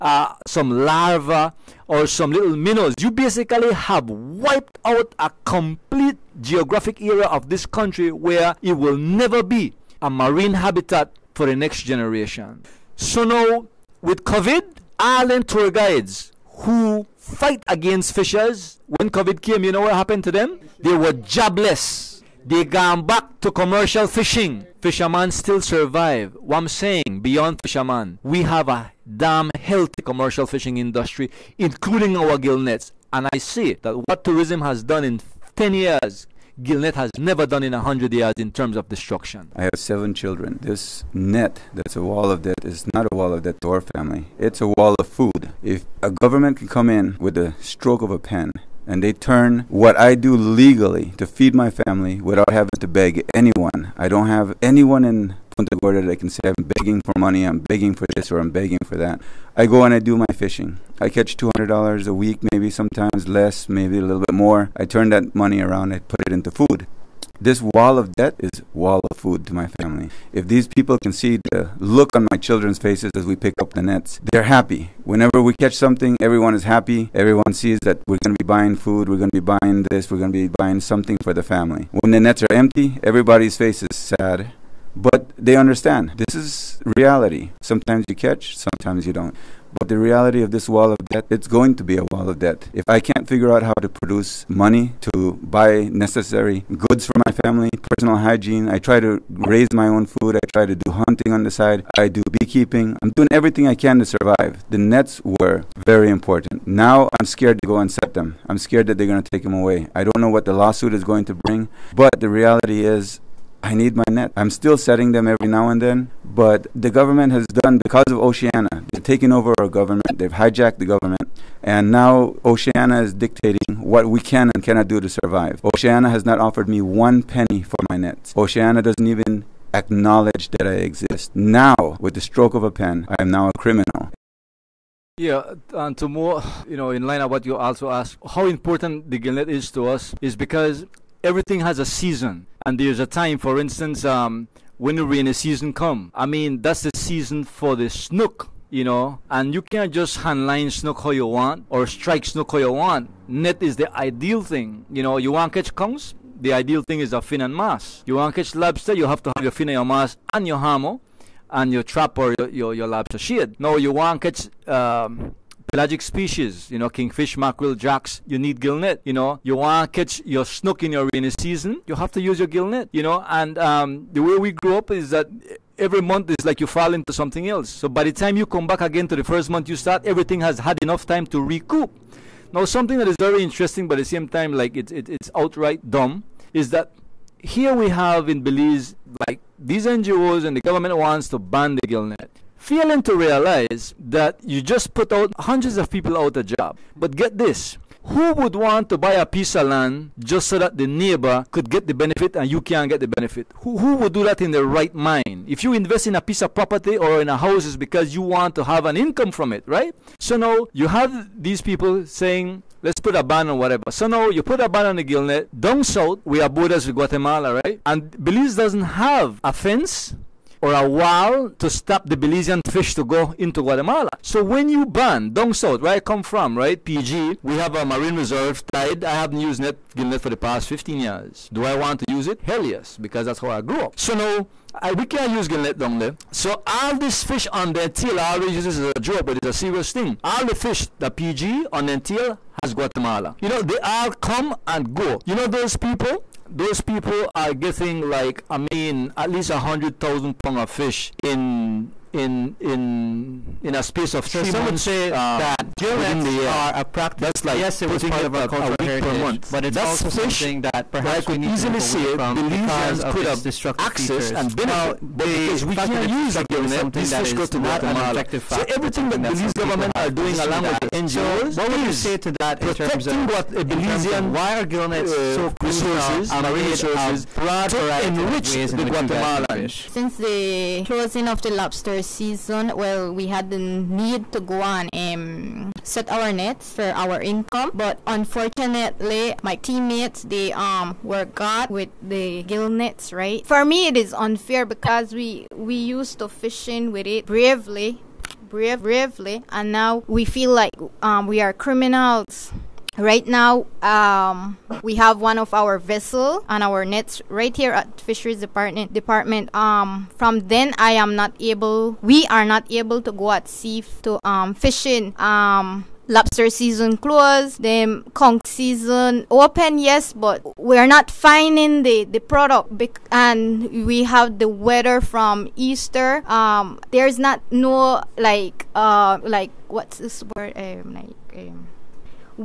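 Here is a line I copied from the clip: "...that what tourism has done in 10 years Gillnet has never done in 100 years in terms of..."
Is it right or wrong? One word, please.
right.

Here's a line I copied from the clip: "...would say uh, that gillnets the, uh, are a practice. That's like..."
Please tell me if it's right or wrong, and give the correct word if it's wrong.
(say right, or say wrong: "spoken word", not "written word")
right.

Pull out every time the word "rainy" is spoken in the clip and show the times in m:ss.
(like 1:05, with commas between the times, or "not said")
2:25, 2:51.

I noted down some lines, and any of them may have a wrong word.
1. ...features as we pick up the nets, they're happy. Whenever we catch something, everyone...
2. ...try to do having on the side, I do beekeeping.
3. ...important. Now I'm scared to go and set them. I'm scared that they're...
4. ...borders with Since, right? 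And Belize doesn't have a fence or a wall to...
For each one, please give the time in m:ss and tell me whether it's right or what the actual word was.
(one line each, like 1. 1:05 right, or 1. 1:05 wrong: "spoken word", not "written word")
1. 1:12 wrong: "faces", not "features"
2. 1:40 wrong: "hunting", not "having"
3. 1:46 right
4. 3:36 wrong: "Guatemala", not "Since".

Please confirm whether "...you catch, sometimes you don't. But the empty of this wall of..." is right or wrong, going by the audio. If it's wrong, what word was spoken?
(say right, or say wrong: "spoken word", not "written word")
wrong: "reality", not "empty".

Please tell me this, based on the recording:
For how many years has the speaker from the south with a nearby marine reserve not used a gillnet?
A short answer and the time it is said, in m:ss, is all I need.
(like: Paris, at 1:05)
15 years, at 3:50.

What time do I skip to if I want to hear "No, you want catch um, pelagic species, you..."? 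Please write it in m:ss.
2:43.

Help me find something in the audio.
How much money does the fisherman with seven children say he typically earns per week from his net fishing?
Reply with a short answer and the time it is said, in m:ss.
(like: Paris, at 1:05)
$200, at 1:01.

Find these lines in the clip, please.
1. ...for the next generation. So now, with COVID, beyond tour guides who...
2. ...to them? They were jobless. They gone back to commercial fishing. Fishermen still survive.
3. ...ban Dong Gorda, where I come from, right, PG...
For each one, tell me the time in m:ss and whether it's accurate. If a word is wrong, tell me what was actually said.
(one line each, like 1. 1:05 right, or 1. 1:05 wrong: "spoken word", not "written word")
1. 0:11 wrong: "island", not "beyond"
2. 0:20 right
3. 3:44 wrong: "South", not "Gorda".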